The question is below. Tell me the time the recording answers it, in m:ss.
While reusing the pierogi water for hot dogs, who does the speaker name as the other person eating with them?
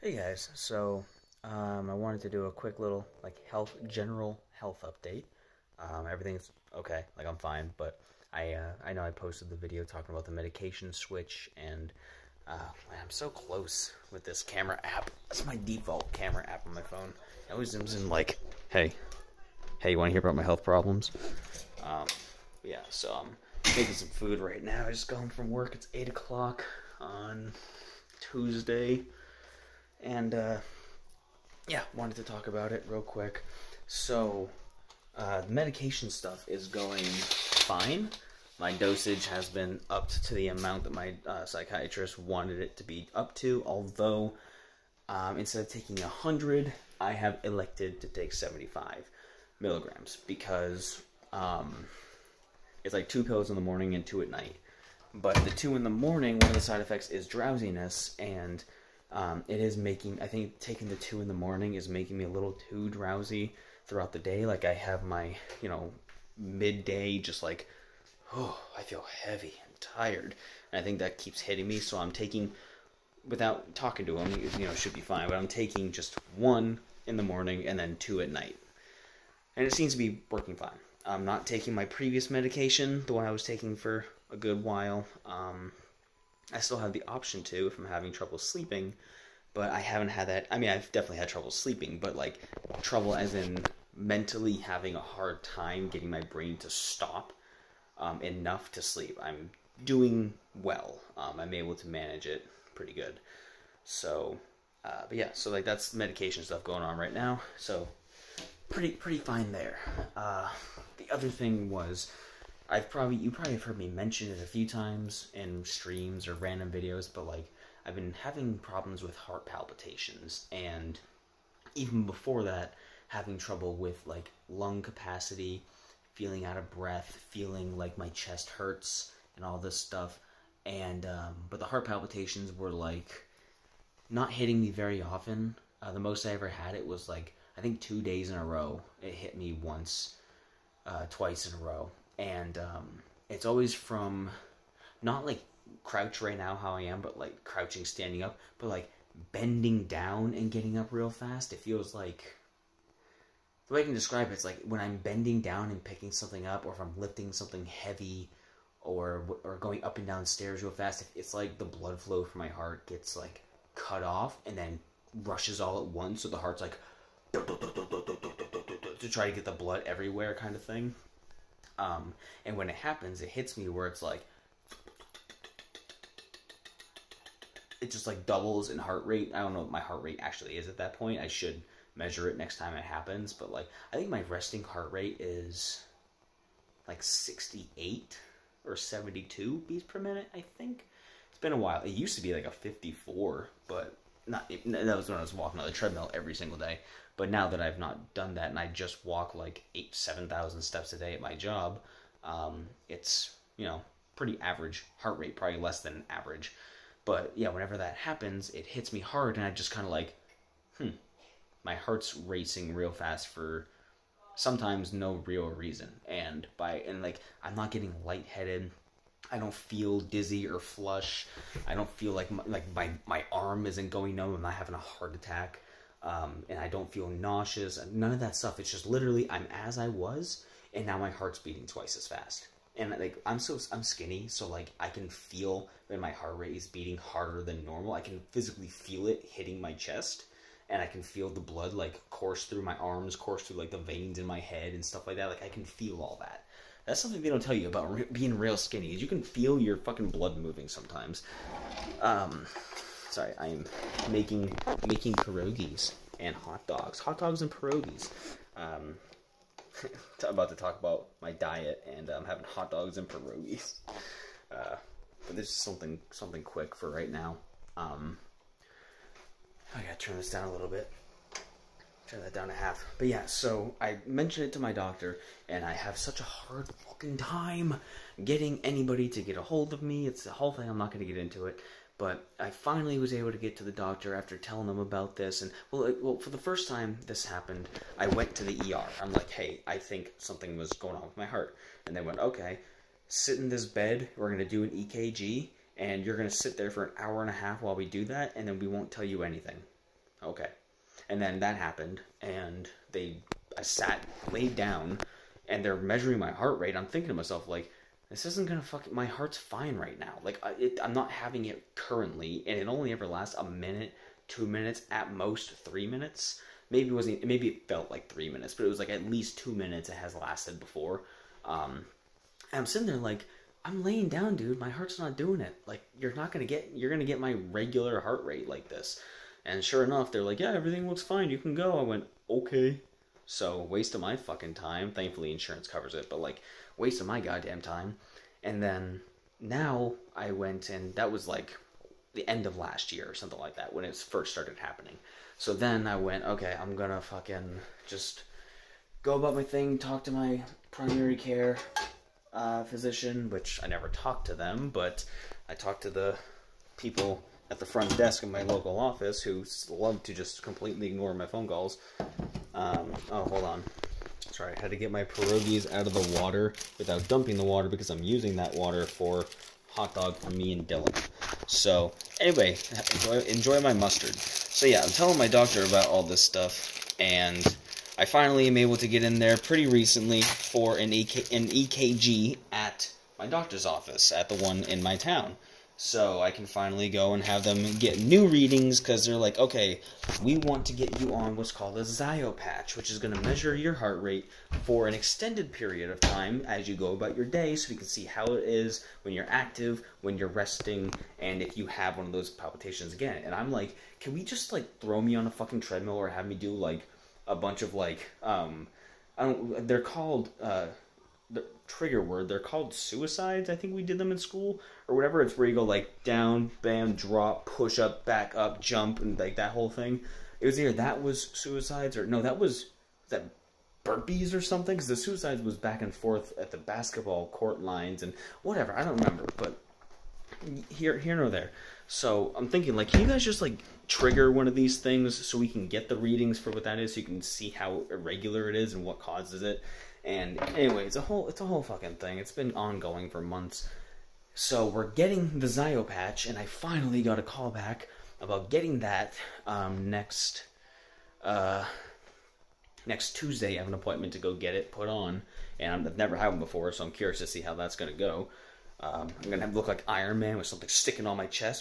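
6:10.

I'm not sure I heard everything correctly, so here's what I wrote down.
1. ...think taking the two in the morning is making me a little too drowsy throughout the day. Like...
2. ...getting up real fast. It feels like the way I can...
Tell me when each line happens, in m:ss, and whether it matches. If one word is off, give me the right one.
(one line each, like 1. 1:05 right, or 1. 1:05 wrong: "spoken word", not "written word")
1. 1:00 right
2. 2:30 right.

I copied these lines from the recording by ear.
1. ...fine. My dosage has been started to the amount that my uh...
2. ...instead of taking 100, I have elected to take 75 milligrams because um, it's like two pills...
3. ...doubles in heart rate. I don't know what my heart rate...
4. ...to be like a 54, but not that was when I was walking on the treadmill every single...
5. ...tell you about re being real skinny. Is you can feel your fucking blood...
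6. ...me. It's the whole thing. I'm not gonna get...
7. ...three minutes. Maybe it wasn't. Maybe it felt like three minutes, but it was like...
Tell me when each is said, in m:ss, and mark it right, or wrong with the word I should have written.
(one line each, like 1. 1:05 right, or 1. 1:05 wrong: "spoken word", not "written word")
1. 0:37 wrong: "upped", not "started"
2. 0:45 right
3. 2:58 right
4. 3:12 right
5. 4:07 right
6. 4:39 right
7. 5:15 right.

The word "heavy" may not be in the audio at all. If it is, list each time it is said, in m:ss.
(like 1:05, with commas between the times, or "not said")
1:09, 2:37.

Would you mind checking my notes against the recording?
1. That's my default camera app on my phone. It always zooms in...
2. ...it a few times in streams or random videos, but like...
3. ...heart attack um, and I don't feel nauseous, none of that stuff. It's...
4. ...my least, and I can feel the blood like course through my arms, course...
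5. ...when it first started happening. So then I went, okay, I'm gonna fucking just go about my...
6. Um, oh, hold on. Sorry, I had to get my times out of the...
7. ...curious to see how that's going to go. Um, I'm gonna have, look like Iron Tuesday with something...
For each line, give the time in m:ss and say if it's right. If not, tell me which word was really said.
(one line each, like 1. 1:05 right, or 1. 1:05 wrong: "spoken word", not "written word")
1. 0:15 right
2. 1:54 right
3. 3:44 right
4. 3:59 wrong: "chest", not "least"
5. 5:43 right
6. 6:02 wrong: "pierogies", not "times"
7. 7:36 wrong: "Man", not "Tuesday".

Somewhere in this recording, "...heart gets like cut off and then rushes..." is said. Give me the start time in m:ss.
2:42.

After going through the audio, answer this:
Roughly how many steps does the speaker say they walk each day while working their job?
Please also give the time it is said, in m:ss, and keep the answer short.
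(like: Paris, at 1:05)
7,000, at 3:19.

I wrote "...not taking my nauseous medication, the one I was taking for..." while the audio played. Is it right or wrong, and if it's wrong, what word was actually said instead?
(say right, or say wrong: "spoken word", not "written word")
wrong: "previous", not "nauseous".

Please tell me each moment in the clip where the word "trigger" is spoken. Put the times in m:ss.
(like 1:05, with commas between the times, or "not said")
6:51, 7:13.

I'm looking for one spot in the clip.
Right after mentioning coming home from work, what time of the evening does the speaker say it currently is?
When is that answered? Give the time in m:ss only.
0:25.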